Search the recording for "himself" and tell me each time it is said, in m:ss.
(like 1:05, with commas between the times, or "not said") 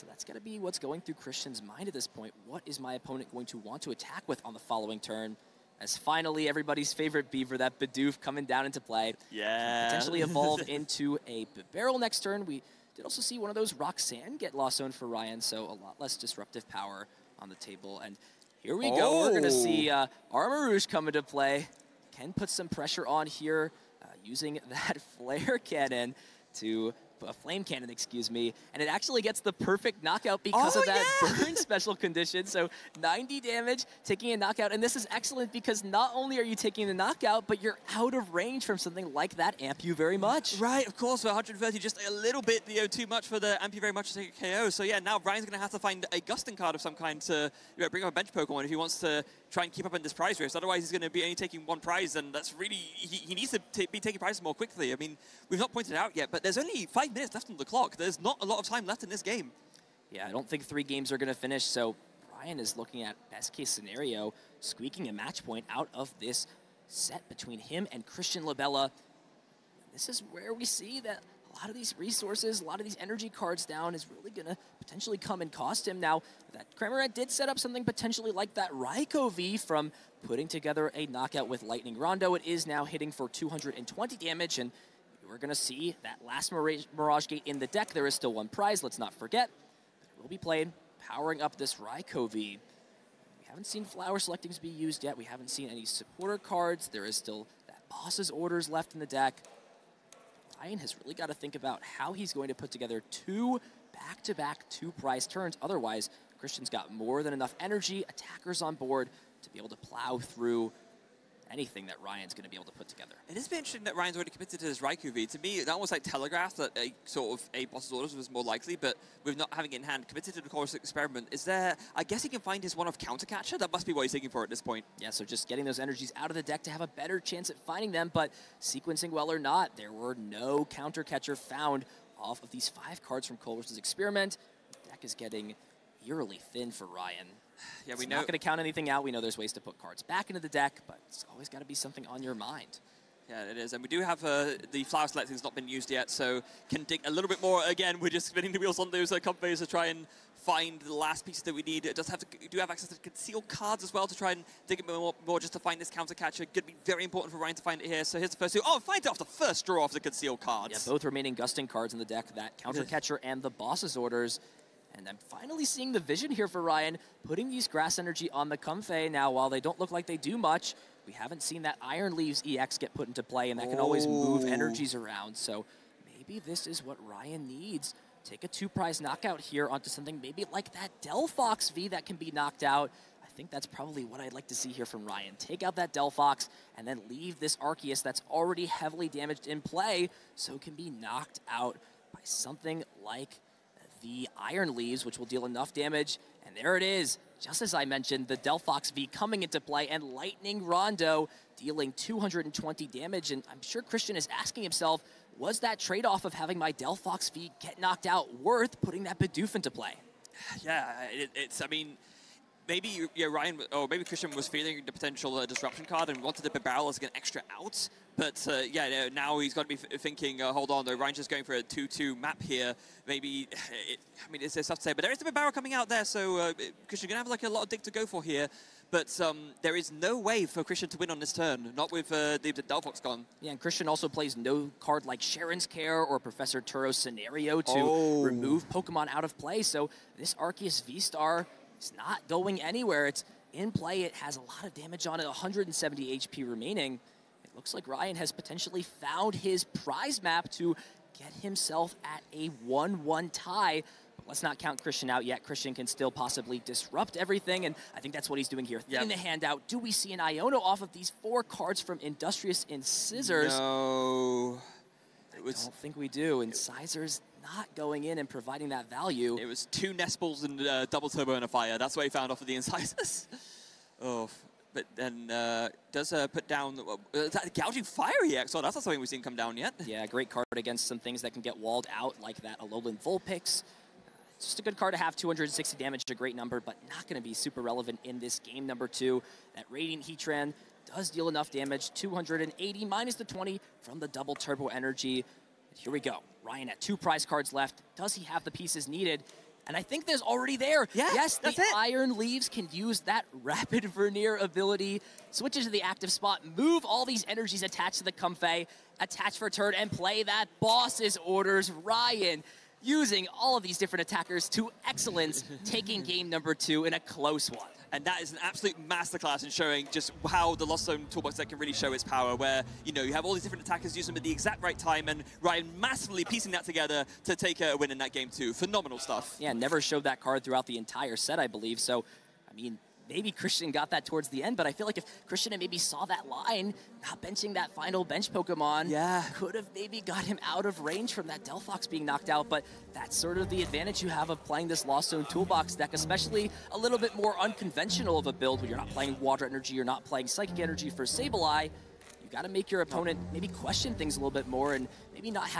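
3:24, 4:11.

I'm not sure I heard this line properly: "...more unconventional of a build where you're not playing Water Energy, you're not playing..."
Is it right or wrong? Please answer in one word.
right.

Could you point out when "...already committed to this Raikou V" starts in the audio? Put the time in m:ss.
1:54.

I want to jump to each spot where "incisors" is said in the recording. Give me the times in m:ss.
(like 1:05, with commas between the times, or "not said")
4:22, 4:32.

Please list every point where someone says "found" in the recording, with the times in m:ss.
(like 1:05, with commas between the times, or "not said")
2:11, 4:08, 4:32.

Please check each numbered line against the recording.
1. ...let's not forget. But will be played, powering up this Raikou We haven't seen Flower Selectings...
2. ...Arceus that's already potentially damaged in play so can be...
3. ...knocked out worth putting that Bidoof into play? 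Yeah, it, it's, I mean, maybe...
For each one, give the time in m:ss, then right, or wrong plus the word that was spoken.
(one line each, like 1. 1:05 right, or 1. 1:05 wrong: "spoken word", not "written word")
1. 1:28 right
2. 3:07 wrong: "heavily", not "potentially"
3. 3:27 right.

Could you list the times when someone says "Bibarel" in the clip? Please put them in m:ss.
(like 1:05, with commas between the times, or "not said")
0:11, 3:36, 3:45.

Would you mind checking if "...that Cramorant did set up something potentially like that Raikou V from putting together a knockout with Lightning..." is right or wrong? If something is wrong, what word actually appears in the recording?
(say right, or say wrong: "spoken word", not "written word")
right.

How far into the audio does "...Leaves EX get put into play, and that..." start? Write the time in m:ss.
2:52.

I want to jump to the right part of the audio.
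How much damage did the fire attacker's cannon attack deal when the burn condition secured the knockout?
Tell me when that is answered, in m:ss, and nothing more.
0:33.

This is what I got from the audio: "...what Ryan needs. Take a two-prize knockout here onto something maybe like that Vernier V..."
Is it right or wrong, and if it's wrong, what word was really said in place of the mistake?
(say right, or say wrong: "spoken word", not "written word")
wrong: "Delphox", not "Vernier".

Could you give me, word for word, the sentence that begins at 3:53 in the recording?
Yeah, and Christian also plays no card like Cheren's Care or Professor Turo's Scenario to oh.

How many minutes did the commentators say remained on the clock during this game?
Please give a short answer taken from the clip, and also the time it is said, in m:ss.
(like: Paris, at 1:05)
5, at 0:57.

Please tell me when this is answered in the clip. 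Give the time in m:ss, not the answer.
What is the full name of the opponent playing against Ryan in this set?
1:08.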